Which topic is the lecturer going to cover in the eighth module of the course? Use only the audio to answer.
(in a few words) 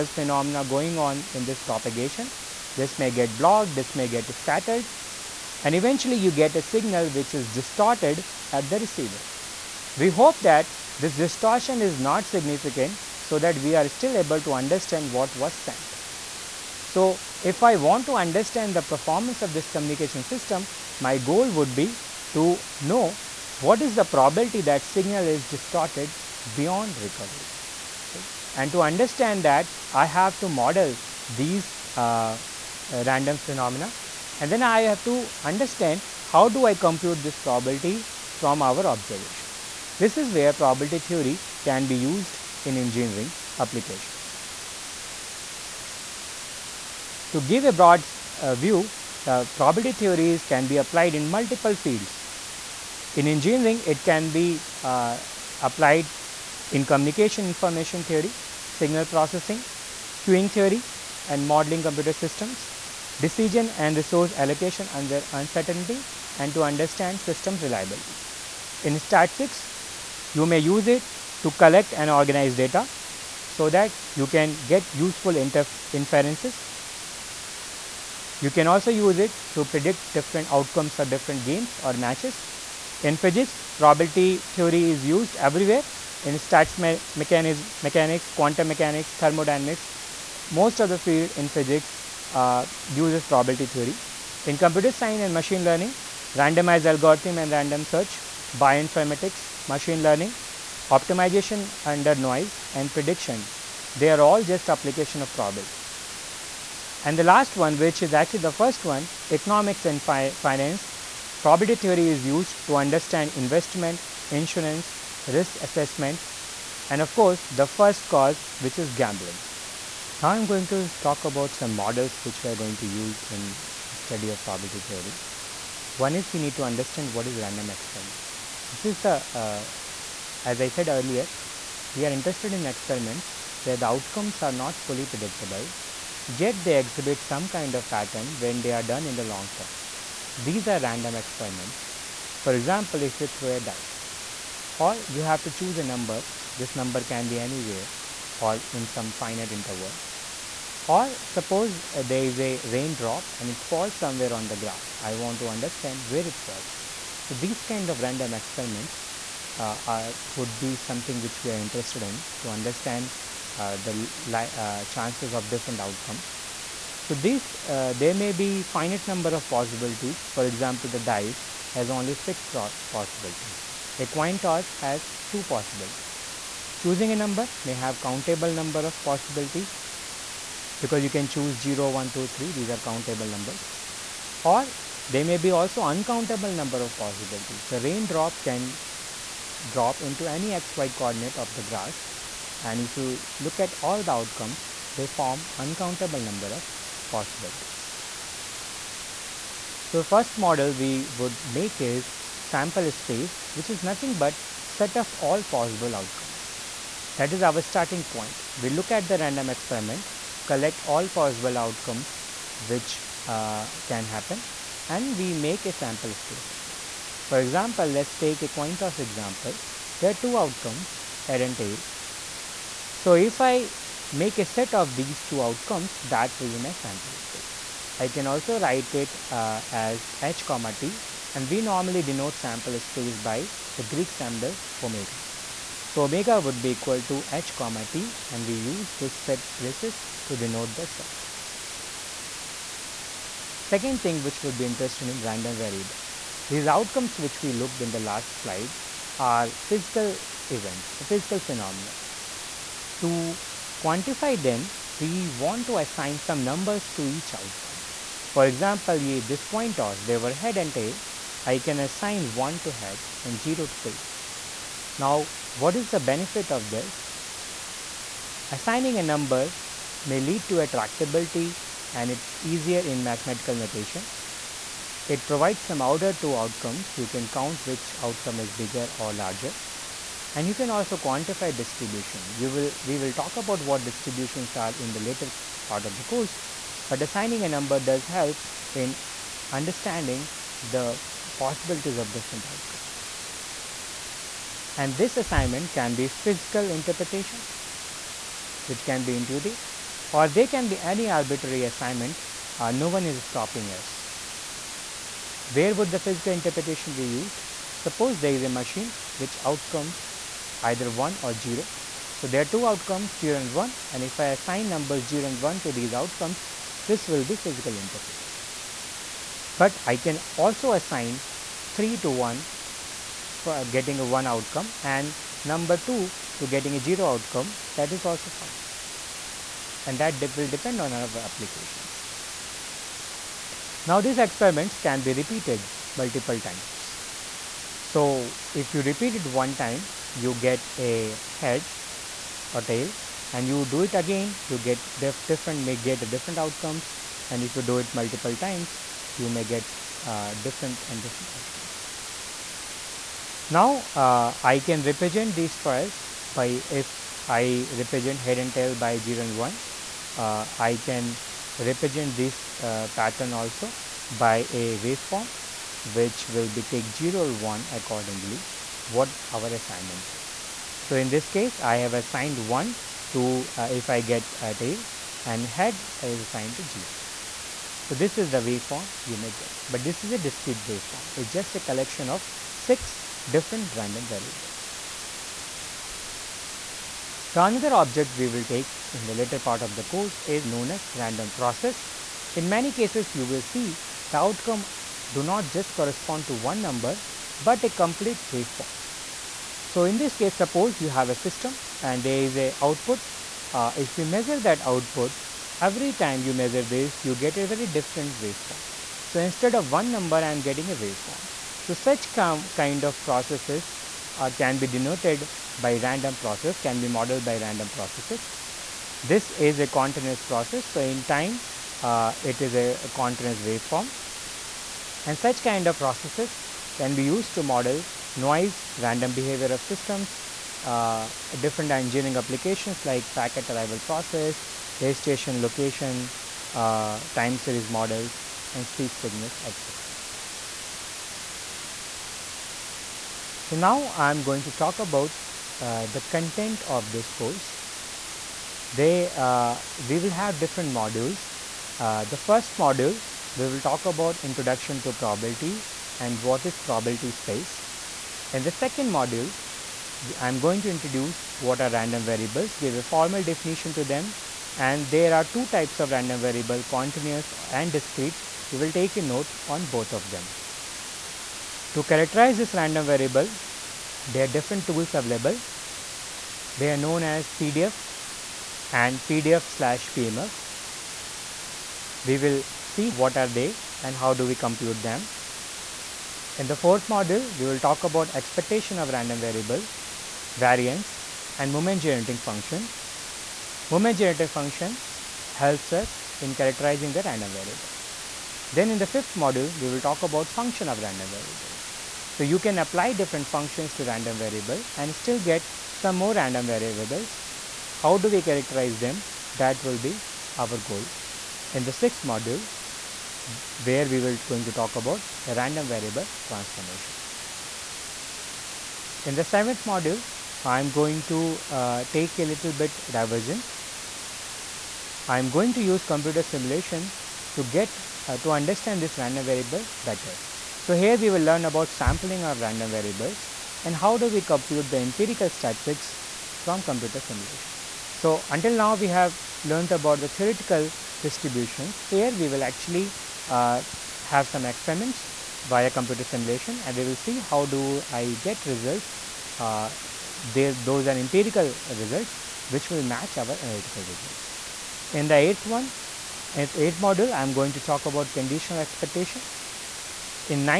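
Conditional expectation.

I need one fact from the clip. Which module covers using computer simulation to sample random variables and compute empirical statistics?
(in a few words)
Seventh module.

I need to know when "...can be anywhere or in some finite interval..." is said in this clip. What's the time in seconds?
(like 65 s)
147 s.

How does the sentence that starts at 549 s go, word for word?
Uh, they, those are empirical results which will match our analytical results.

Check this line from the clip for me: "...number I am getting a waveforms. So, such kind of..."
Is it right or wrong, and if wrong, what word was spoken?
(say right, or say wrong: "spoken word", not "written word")
right.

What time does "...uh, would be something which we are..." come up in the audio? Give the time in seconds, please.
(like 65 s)
159 s.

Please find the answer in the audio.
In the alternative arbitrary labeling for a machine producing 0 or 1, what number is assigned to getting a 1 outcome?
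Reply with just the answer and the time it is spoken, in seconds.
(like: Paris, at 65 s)
3, at 319 s.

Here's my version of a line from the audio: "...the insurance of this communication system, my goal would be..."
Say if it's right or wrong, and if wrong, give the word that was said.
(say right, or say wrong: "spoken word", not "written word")
wrong: "performance", not "insurance".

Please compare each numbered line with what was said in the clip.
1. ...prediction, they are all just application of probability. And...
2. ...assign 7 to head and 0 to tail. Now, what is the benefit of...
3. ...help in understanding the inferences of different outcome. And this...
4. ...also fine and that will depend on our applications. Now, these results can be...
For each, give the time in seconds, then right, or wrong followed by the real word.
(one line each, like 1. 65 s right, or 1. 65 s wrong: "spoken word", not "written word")
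1. 102 s right
2. 261 s wrong: "1", not "7"
3. 288 s wrong: "possibilities", not "inferences"
4. 328 s wrong: "experiments", not "results".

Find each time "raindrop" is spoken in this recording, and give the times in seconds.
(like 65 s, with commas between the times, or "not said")
152 s, 187 s.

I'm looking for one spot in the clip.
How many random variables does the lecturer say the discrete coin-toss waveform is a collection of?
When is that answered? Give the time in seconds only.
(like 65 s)
382 s.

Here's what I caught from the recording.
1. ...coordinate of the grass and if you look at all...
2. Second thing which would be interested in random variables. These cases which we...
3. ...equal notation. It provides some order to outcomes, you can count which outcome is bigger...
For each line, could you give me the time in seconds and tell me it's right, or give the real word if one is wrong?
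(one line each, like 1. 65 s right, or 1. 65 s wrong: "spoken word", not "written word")
1. 190 s right
2. 243 s wrong: "outcomes", not "cases"
3. 273 s wrong: "mathematical", not "equal".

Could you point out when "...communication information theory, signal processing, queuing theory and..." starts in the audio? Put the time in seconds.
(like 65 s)
56 s.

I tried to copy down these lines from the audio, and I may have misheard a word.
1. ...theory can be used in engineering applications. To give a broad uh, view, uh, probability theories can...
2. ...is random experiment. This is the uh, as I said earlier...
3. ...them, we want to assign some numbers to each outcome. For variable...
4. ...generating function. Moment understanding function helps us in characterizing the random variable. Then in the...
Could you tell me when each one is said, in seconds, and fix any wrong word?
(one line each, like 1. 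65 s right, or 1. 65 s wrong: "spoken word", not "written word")
1. 41 s right
2. 127 s right
3. 254 s wrong: "example", not "variable"
4. 491 s wrong: "generating", not "understanding".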